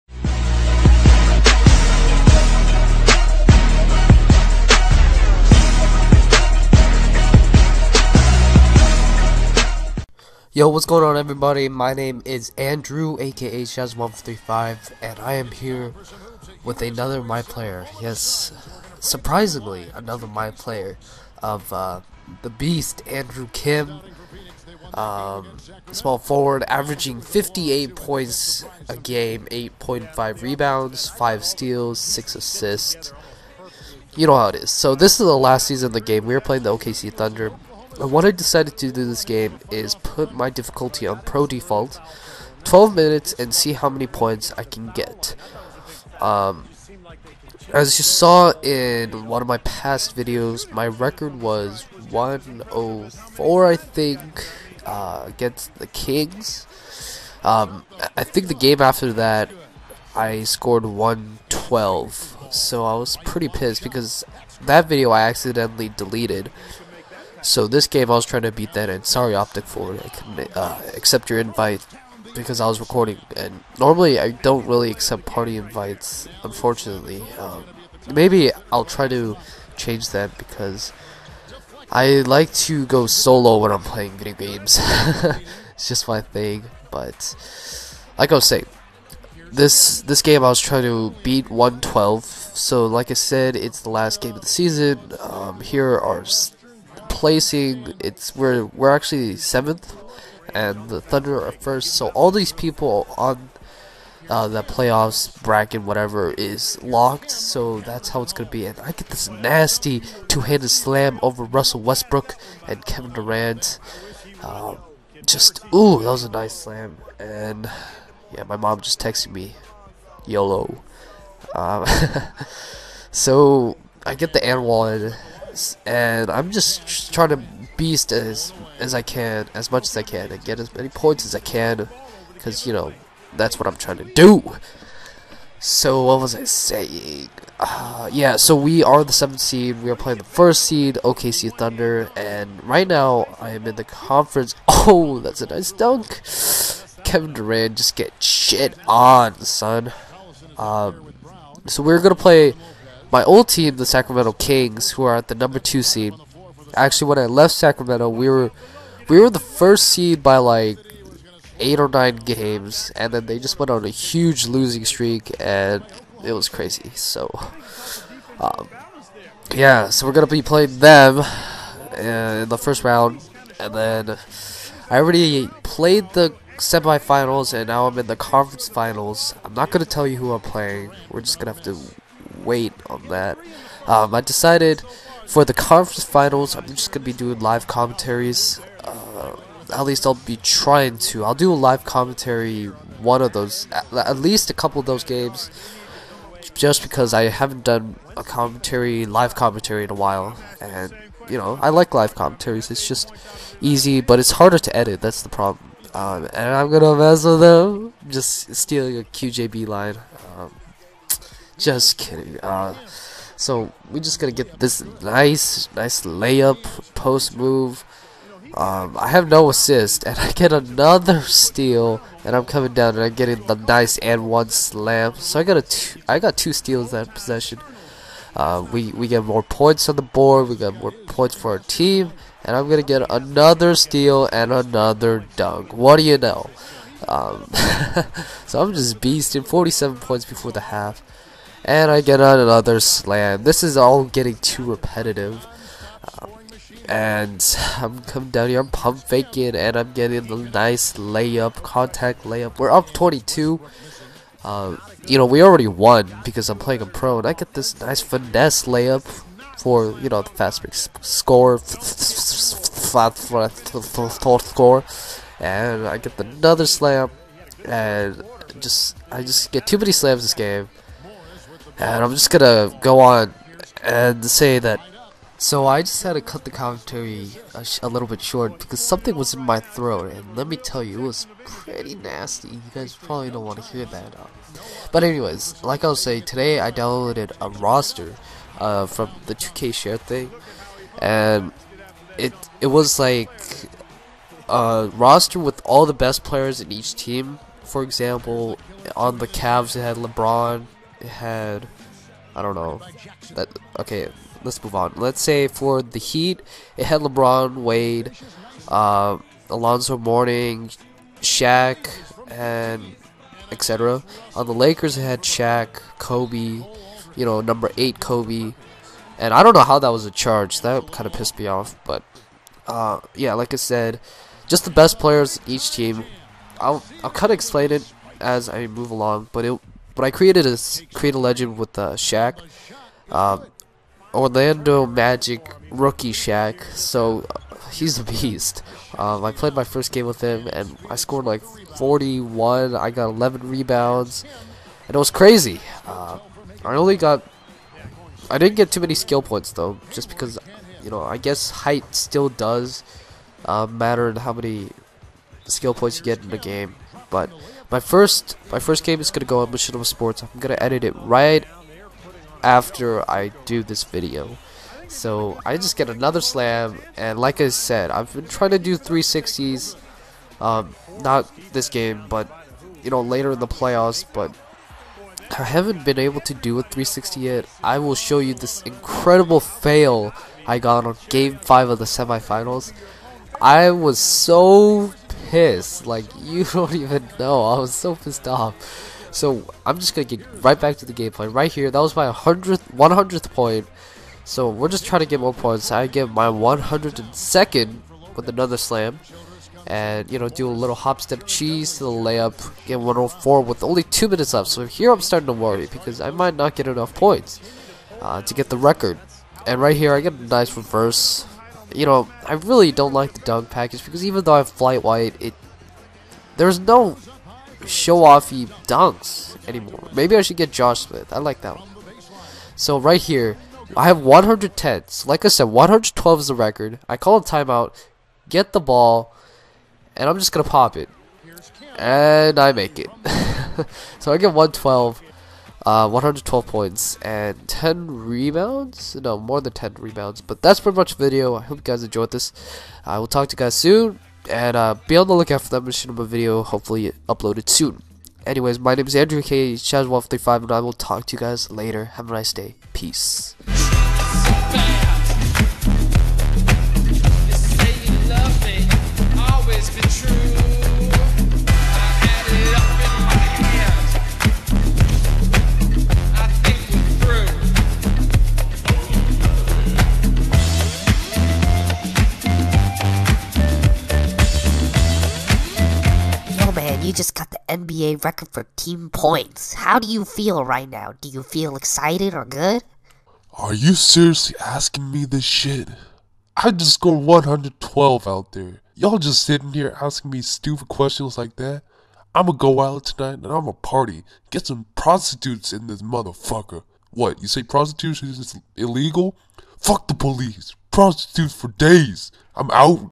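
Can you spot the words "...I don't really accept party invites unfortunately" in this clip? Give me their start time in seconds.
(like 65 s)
74 s.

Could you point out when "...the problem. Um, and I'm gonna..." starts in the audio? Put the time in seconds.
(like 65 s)
205 s.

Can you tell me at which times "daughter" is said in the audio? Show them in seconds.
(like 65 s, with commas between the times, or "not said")
not said.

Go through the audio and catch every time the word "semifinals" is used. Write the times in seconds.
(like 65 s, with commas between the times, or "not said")
176 s, 381 s.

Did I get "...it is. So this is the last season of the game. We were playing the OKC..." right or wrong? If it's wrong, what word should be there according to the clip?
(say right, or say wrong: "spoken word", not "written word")
right.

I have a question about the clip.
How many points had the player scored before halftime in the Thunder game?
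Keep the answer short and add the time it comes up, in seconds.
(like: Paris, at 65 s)
47, at 239 s.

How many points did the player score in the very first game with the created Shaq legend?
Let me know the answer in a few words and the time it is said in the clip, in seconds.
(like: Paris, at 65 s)
41, at 341 s.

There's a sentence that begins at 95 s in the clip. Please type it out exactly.
Um, here are placing it's we're we're actually seventh, and the Thunder are first.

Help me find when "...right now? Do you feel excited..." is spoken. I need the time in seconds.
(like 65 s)
480 s.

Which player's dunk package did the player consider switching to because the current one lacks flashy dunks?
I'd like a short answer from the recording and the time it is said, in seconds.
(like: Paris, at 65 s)
Josh Smith, at 420 s.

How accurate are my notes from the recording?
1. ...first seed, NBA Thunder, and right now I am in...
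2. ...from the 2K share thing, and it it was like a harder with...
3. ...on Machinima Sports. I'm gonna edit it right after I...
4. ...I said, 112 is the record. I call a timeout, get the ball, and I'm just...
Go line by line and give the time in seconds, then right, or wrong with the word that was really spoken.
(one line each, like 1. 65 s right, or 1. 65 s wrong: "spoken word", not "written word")
1. 140 s wrong: "OKC", not "NBA"
2. 288 s wrong: "roster", not "harder"
3. 359 s right
4. 425 s right.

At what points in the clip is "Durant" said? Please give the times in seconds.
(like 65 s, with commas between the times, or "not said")
113 s, 147 s.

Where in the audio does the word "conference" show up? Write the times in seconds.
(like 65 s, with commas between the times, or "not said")
143 s, 178 s, 185 s.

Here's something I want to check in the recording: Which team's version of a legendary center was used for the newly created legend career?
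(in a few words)
Orlando Magic.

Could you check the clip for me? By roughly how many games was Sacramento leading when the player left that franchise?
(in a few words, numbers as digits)
8 or 9.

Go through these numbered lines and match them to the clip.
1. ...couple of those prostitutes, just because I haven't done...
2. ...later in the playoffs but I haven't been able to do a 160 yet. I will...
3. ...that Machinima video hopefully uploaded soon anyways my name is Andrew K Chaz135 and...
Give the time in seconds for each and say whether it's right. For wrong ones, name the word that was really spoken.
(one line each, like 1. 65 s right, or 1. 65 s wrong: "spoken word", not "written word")
1. 194 s wrong: "games", not "prostitutes"
2. 372 s wrong: "360", not "160"
3. 445 s right.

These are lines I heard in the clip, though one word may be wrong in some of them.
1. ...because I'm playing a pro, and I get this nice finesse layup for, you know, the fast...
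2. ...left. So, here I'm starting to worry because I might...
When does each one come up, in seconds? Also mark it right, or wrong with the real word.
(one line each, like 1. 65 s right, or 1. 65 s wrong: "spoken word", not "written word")
1. 256 s right
2. 404 s right.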